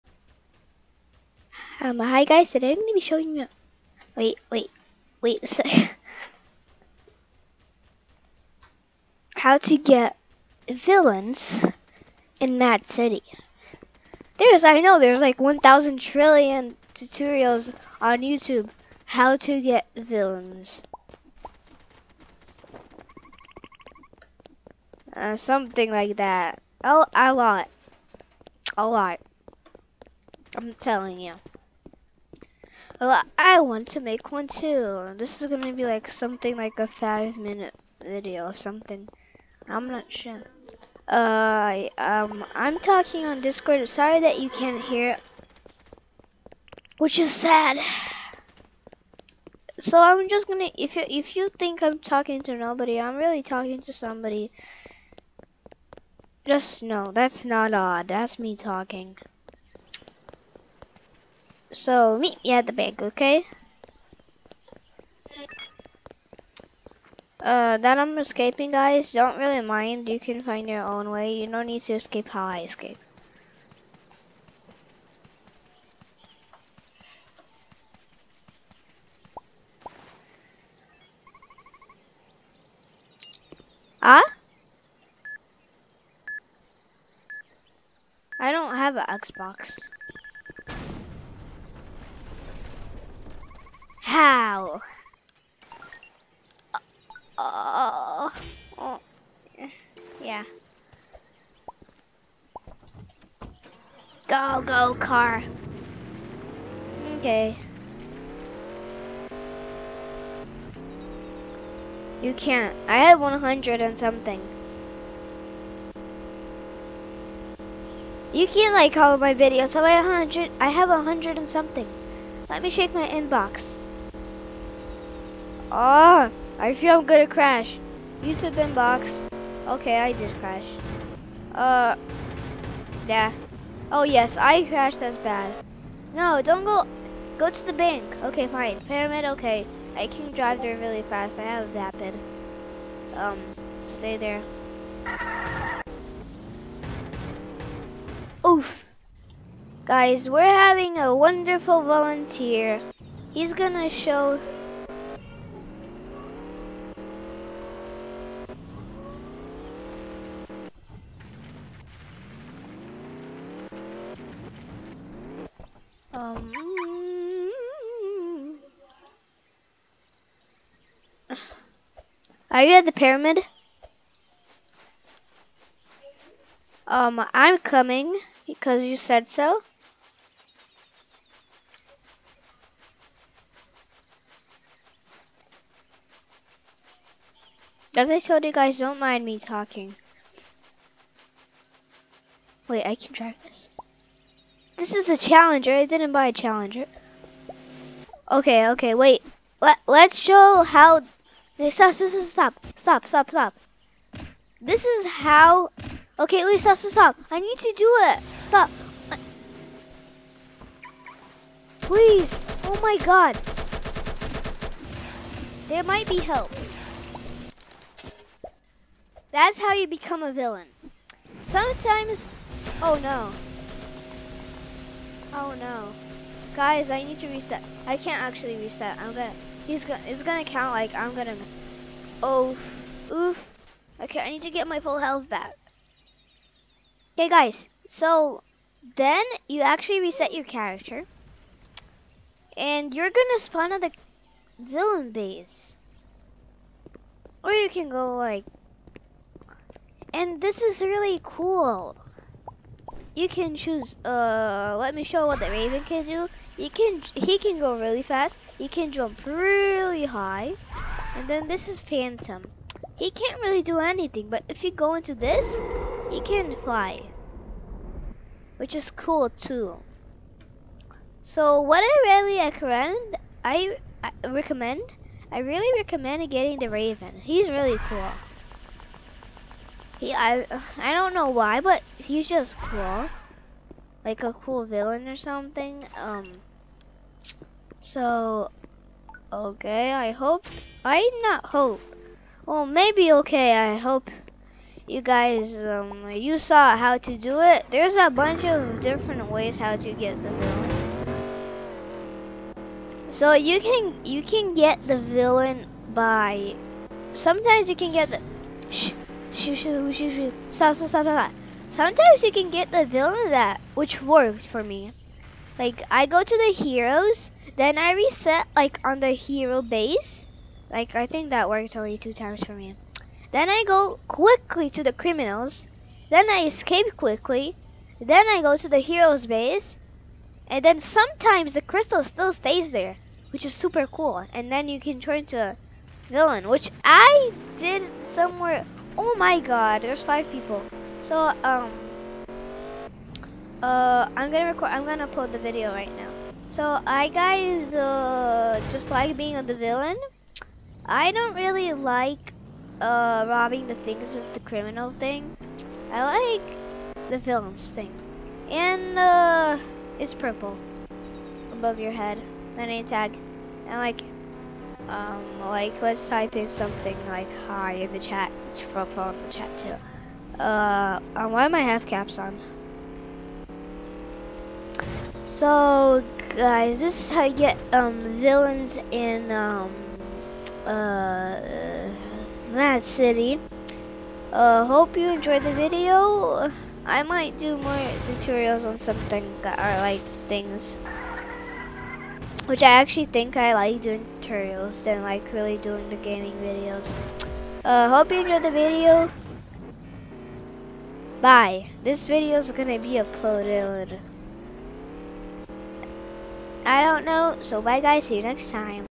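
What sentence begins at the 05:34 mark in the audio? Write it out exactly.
And then you can turn to a villain, which I did somewhere Oh my god, there's five people.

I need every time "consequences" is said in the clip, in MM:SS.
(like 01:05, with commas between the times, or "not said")
not said.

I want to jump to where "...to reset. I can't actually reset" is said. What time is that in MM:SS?
03:47.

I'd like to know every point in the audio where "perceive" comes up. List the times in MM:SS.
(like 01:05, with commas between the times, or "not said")
not said.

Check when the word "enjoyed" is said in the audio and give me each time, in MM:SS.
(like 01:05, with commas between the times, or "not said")
06:25, 06:38.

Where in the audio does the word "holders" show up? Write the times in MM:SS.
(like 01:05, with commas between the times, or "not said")
not said.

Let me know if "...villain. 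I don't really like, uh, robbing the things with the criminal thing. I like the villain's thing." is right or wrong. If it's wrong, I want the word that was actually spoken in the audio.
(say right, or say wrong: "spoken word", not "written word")
right.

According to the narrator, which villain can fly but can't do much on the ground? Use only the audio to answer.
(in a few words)
Phantom.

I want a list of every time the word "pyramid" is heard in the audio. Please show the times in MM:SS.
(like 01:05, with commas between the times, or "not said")
02:18, 02:52.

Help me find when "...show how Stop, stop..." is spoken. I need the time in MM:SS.
03:20.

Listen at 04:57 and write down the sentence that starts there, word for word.
There's a bunch of different ways how to get the villain.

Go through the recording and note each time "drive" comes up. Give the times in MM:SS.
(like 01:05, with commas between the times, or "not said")
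02:20, 03:13.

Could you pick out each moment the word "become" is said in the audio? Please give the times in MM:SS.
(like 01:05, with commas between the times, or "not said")
03:39.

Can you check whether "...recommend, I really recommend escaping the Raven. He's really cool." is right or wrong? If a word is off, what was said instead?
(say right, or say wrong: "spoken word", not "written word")
wrong: "getting", not "escaping".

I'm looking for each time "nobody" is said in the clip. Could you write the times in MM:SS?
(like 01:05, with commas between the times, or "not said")
00:52.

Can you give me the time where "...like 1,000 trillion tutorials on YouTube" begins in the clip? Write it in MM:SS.
00:15.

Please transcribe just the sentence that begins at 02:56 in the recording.
Um, I'm coming because you said so.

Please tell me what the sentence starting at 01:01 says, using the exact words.
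So meet me at the bank, okay?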